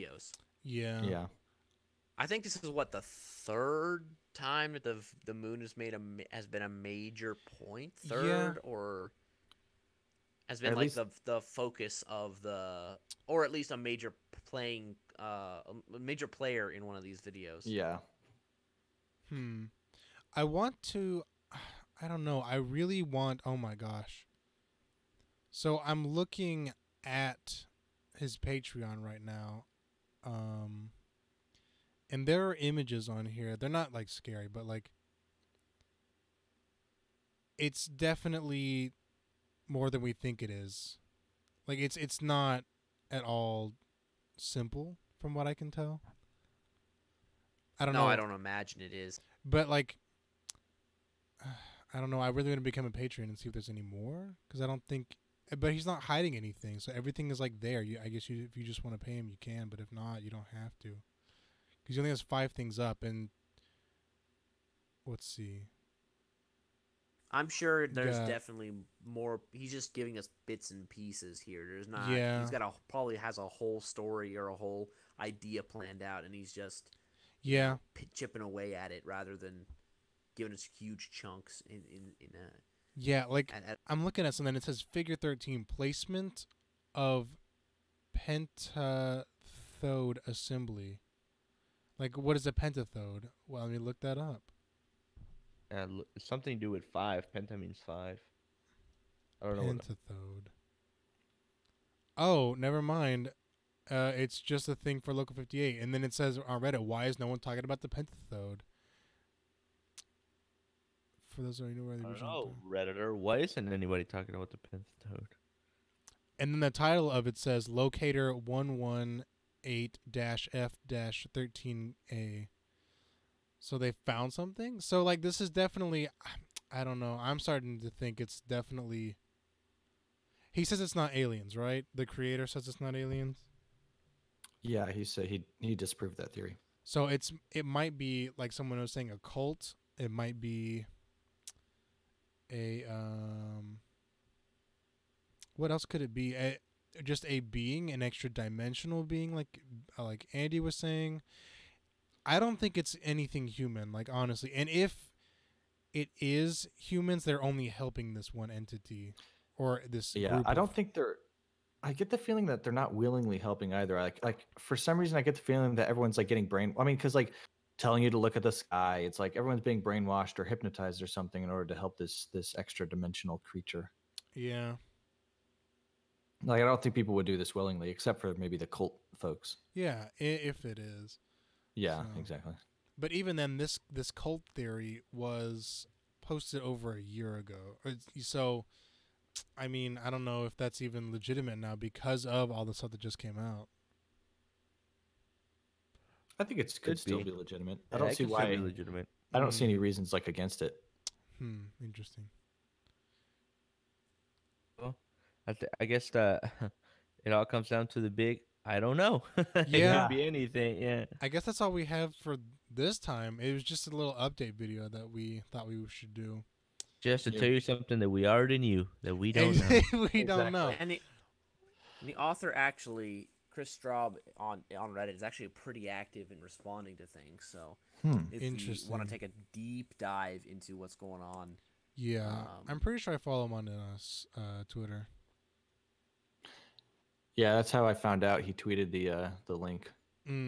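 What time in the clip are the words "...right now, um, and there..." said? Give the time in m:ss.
0:29.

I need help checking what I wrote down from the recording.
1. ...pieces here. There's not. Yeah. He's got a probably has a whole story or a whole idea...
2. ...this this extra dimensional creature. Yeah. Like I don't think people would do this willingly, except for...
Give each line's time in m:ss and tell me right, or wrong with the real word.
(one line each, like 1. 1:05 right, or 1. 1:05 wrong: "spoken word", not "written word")
1. 1:10 right
2. 2:51 right.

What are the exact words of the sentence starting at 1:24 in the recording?
It says figure 13 placement of pentathode assembly.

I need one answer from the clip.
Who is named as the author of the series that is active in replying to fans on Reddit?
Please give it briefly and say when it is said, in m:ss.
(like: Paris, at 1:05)
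Kris Straub, at 3:43.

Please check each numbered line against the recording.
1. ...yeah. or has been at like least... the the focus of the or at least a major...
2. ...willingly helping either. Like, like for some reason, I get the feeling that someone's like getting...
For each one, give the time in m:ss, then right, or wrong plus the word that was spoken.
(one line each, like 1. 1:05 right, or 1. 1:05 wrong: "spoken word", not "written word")
1. 0:08 right
2. 2:42 wrong: "everyone", not "someone".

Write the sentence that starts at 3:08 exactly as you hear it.
So, I mean, I don't know if that's even legitimate now because of all the stuff that just came out.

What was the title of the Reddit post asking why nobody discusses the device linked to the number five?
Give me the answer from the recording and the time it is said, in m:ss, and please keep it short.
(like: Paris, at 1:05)
Locator 118 F 13A, at 1:57.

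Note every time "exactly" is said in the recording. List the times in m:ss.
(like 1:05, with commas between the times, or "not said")
3:02, 3:39.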